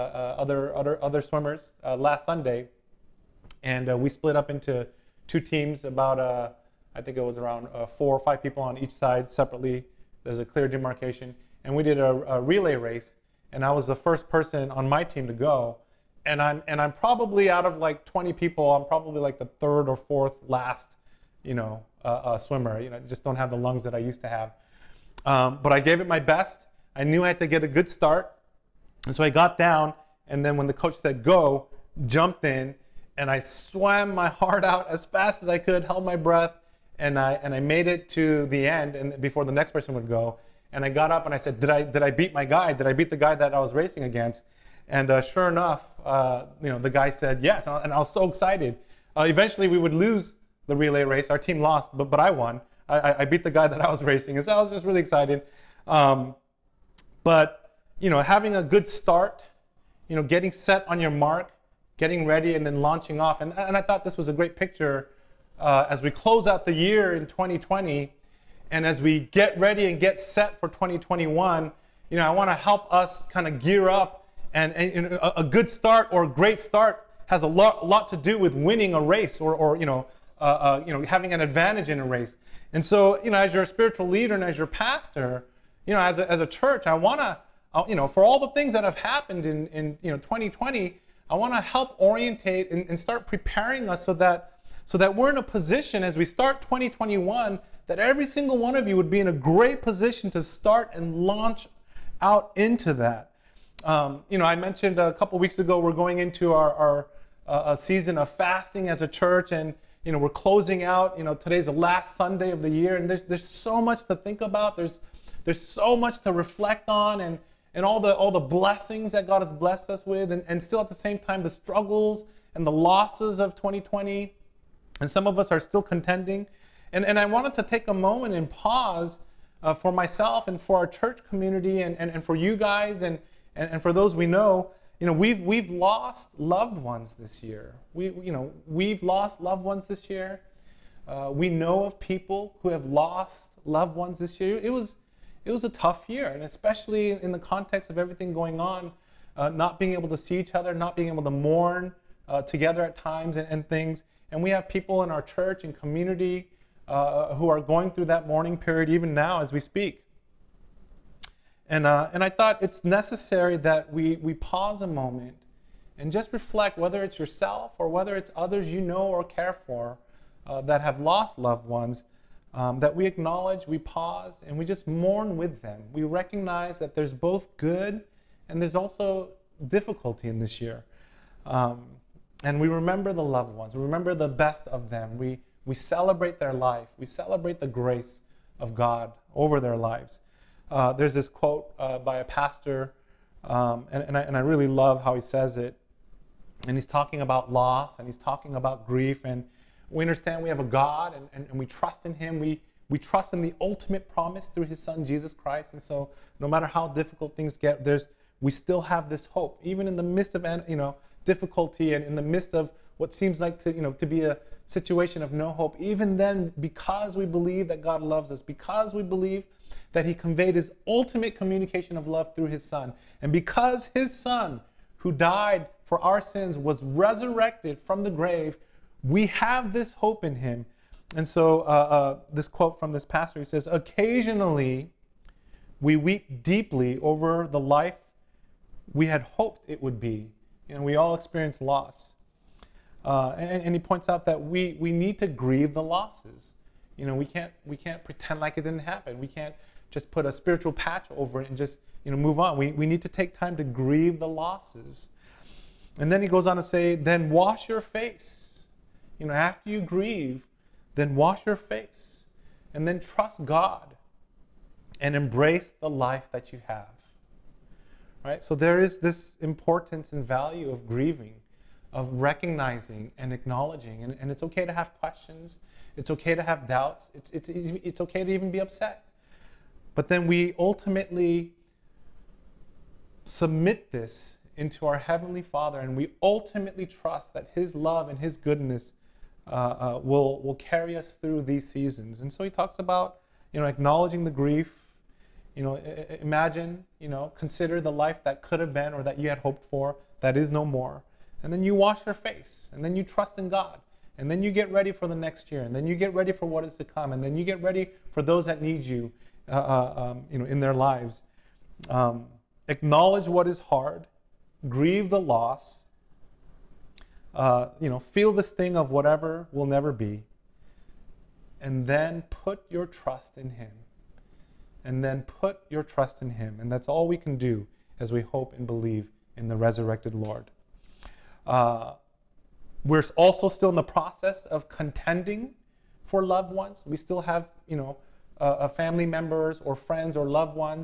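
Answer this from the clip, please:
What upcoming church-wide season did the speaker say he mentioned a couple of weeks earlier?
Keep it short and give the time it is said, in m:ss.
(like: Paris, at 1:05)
fasting, at 1:48.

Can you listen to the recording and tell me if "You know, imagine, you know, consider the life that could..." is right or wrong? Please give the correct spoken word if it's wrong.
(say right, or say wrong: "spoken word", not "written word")
right.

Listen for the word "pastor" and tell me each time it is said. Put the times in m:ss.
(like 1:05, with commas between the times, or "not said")
1:24, 3:12, 3:53.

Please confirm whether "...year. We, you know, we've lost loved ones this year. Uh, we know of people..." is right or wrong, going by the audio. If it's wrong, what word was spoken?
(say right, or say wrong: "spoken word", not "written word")
right.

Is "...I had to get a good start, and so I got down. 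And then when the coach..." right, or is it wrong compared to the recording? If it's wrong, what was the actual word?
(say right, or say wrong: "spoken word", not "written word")
right.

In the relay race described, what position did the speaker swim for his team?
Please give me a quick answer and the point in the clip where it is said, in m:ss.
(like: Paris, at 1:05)
first, at 0:13.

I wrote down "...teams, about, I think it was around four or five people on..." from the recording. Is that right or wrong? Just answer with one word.
right.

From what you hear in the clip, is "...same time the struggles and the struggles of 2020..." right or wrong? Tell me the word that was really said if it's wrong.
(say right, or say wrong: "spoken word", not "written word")
wrong: "losses", not "struggles".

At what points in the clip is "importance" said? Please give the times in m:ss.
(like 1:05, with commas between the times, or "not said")
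4:29.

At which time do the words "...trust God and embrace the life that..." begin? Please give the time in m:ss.
4:22.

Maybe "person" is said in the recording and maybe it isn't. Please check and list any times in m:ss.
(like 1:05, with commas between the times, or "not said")
0:14, 0:39.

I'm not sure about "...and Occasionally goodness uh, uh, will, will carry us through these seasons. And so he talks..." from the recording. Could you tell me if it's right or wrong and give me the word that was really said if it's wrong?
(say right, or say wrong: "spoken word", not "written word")
wrong: "His", not "Occasionally".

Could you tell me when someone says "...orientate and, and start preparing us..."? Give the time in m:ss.
1:31.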